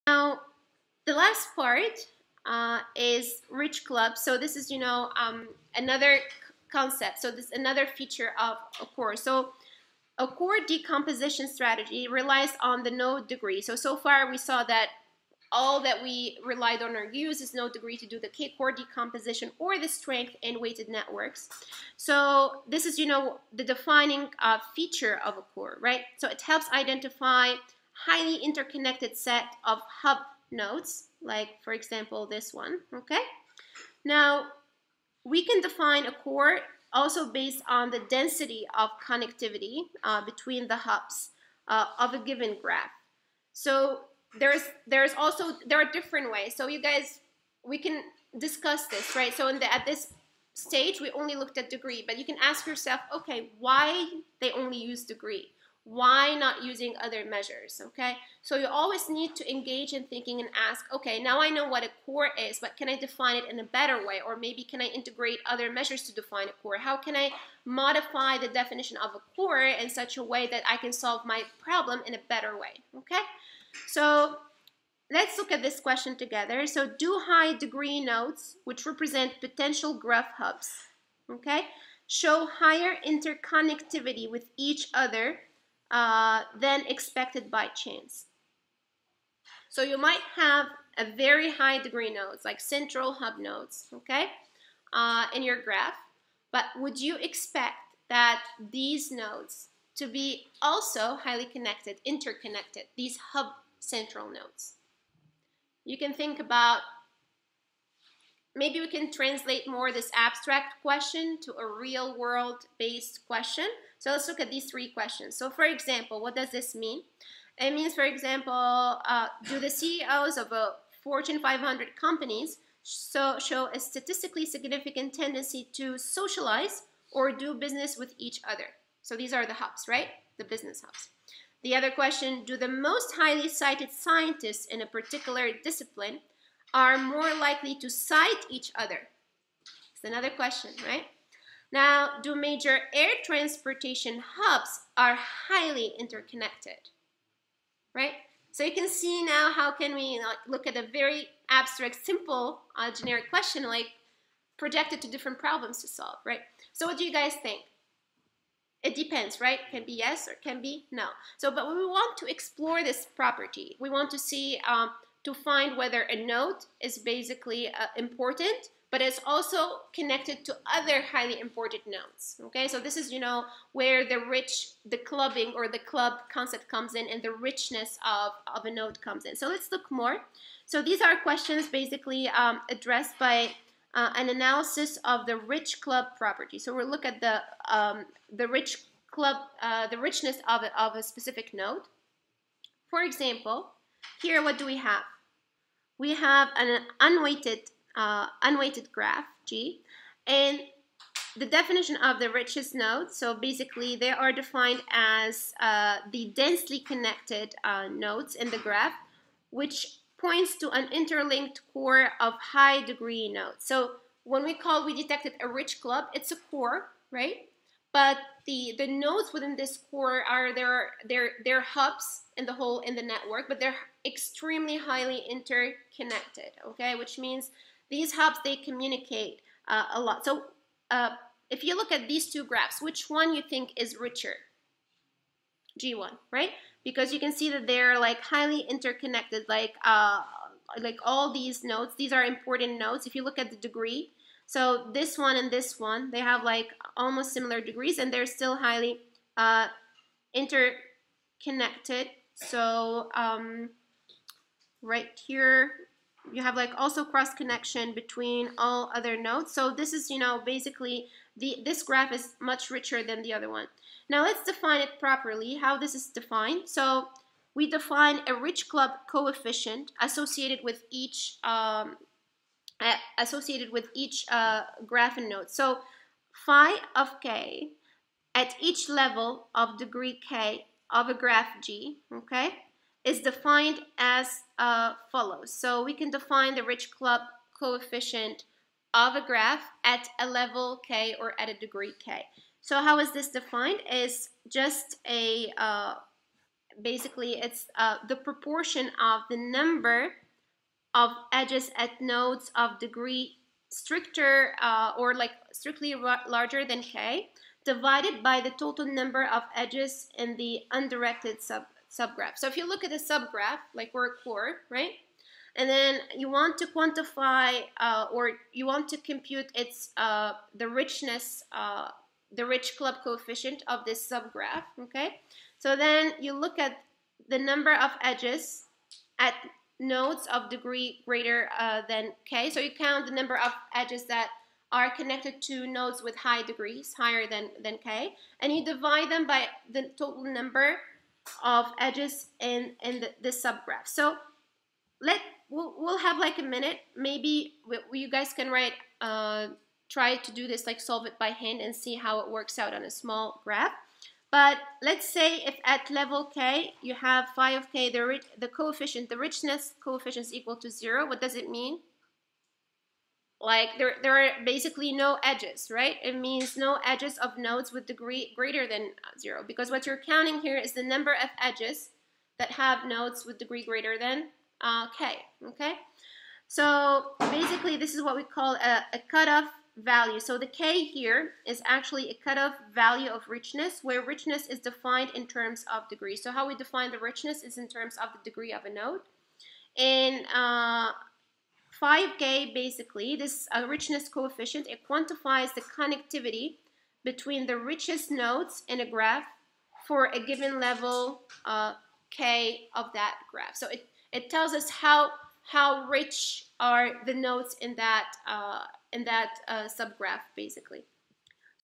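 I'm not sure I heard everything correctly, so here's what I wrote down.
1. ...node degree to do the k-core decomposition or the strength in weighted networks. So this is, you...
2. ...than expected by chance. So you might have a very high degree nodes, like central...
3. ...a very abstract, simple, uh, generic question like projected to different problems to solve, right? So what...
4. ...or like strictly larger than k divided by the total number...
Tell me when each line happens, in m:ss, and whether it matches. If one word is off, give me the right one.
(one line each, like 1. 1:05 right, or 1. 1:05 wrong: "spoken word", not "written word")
1. 0:17 right
2. 1:26 right
3. 2:30 right
4. 5:04 right.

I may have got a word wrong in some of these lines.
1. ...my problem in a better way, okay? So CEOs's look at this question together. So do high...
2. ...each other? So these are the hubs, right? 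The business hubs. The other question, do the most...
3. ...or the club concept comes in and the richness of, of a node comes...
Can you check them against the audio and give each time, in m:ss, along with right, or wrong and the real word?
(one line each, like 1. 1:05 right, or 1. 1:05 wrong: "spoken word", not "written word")
1. 1:11 wrong: "Let", not "CEOs"
2. 2:08 right
3. 2:55 right.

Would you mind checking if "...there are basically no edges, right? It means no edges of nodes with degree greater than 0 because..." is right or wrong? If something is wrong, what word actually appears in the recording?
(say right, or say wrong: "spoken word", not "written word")
right.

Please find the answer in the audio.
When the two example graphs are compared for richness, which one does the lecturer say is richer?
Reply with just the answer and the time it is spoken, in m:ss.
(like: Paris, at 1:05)
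G1, at 3:55.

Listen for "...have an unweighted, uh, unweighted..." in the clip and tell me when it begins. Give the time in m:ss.
3:16.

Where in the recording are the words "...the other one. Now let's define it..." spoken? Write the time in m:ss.
4:23.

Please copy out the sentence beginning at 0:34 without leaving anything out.
Now, we can define a core also based on the density of connectivity uh, between the hubs uh, of a given graph.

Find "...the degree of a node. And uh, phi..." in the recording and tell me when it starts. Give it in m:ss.
6:28.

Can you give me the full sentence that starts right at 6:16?
So basically this is what we call a, a cutoff value.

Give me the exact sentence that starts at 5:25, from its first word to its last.
So then you look at the number of edges at nodes of degree greater uh, than k.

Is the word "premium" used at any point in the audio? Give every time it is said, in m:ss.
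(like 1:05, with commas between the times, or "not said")
not said.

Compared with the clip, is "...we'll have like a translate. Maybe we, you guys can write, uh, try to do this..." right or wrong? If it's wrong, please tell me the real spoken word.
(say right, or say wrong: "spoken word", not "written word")
wrong: "minute", not "translate".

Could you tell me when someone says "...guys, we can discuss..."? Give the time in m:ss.
0:46.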